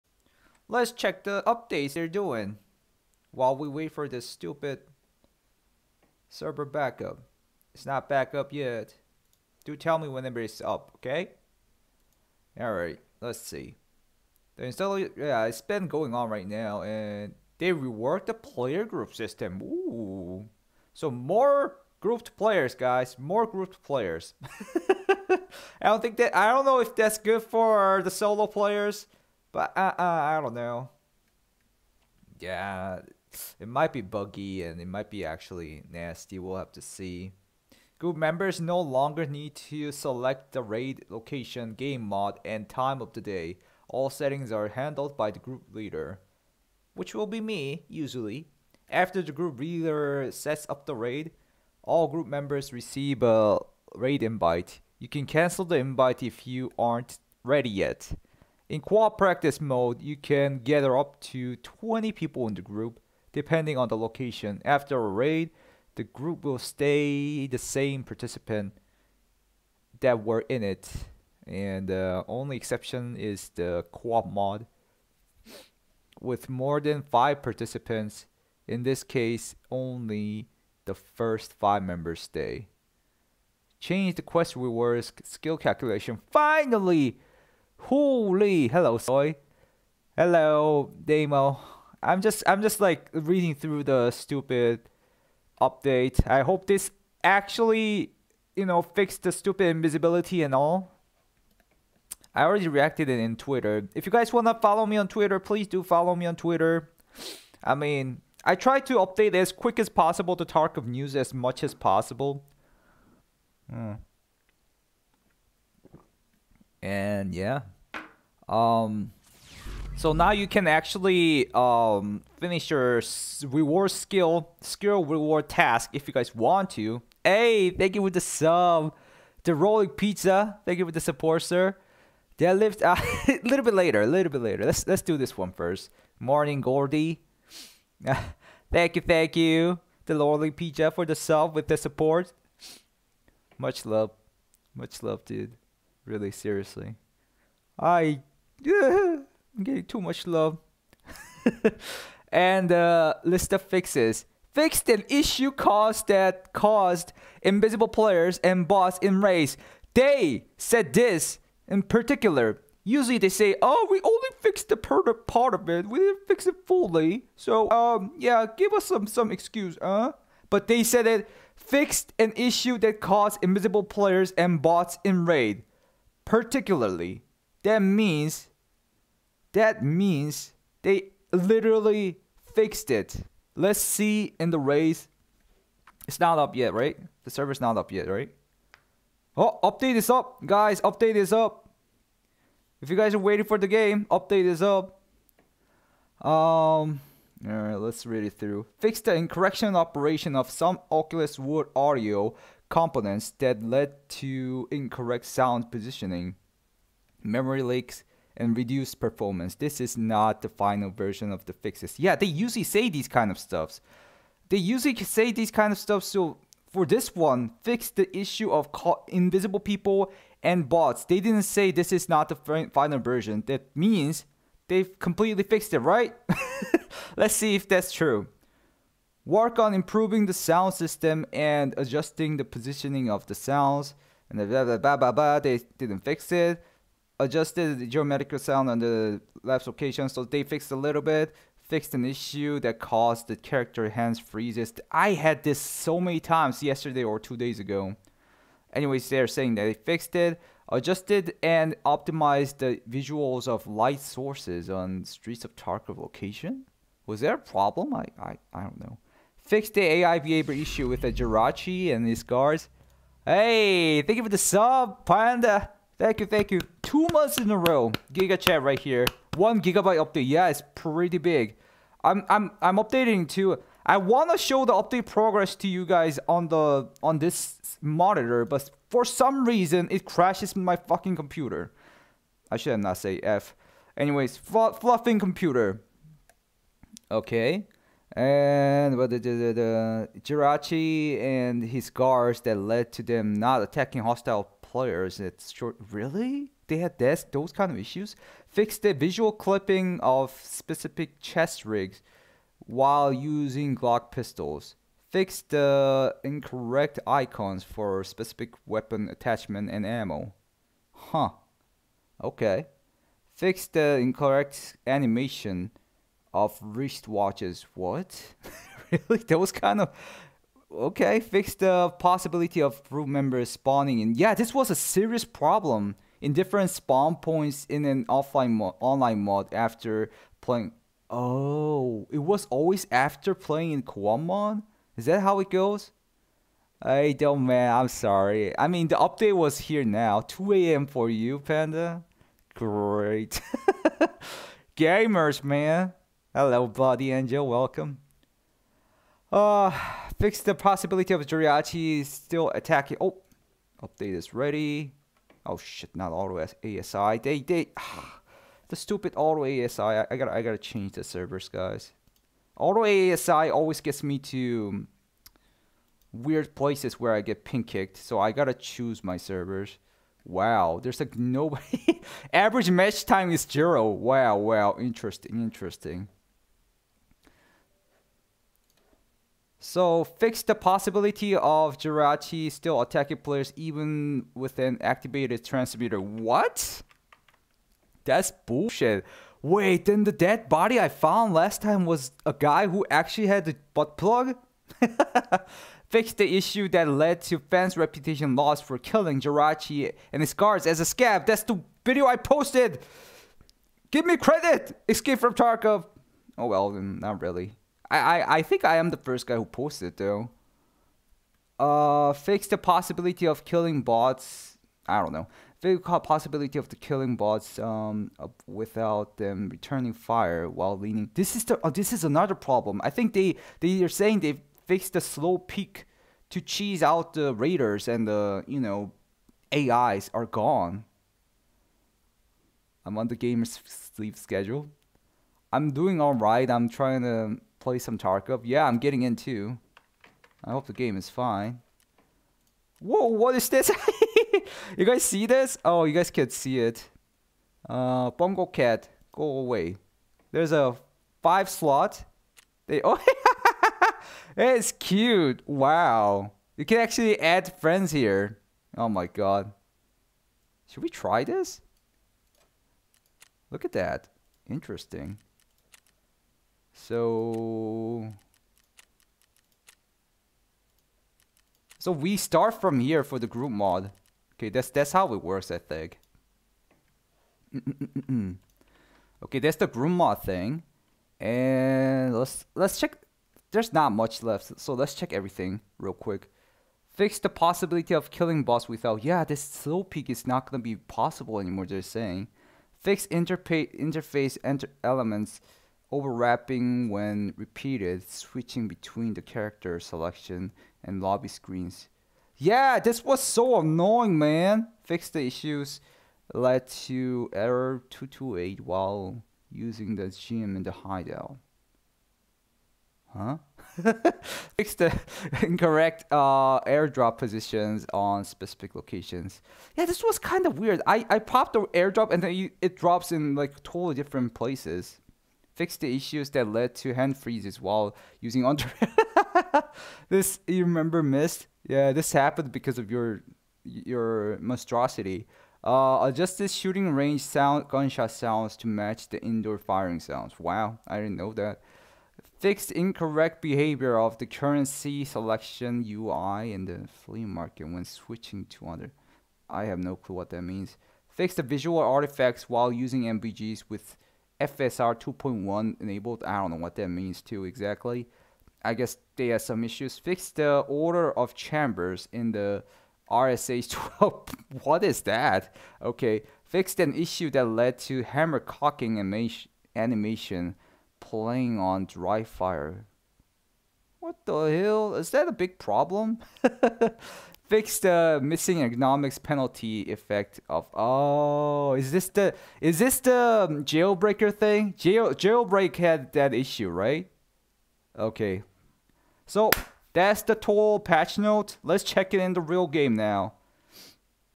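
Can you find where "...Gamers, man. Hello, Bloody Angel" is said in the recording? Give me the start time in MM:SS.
05:44.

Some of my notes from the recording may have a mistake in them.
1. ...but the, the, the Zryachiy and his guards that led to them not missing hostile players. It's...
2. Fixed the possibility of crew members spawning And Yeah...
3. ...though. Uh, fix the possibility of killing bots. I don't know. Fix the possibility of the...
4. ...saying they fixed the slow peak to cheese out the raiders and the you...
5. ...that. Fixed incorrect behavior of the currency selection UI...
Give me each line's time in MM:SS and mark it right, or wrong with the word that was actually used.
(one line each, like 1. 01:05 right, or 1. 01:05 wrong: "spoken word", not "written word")
1. 04:48 wrong: "attacking", not "missing"
2. 05:21 right
3. 06:49 right
4. 07:03 right
5. 09:01 right.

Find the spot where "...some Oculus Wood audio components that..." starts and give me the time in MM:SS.
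03:20.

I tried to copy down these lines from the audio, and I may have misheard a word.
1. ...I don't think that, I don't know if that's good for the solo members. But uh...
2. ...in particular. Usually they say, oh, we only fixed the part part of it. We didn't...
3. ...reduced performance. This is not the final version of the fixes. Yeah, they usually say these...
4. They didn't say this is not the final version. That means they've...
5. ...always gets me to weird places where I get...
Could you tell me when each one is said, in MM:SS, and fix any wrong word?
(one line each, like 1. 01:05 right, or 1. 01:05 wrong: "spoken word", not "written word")
1. 00:25 wrong: "players", not "members"
2. 02:41 right
3. 03:28 right
4. 03:41 right
5. 06:03 right.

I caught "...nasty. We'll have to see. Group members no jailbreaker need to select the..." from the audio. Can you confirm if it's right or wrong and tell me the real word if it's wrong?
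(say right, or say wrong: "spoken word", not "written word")
wrong: "longer", not "jailbreaker".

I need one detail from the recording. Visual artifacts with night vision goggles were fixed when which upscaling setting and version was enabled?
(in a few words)
FSR 2.1.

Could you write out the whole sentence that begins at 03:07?
The server's not up yet, right?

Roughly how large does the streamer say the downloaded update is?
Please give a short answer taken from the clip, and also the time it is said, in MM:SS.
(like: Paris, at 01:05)
1 gigabyte, at 04:29.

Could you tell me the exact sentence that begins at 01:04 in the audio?
After a raid, the group will stay the same participant that were in it.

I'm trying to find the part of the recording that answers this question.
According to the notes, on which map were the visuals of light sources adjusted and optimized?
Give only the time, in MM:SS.
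04:15.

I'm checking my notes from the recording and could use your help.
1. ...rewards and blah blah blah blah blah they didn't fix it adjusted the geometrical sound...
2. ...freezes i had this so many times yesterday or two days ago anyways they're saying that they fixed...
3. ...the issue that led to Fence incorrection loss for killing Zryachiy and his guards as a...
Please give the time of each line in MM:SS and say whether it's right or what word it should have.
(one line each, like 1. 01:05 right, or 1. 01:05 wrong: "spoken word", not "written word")
1. 03:53 wrong: "sounds", not "rewards"
2. 04:04 right
3. 06:36 wrong: "reputation", not "incorrection".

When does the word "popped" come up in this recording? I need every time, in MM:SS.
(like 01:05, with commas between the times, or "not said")
08:41.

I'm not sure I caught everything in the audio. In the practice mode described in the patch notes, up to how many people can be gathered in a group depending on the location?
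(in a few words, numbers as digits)
20.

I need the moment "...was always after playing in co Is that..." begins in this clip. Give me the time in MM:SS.
05:32.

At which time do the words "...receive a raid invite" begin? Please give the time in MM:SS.
00:52.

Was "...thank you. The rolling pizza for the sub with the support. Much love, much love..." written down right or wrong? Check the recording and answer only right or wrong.
right.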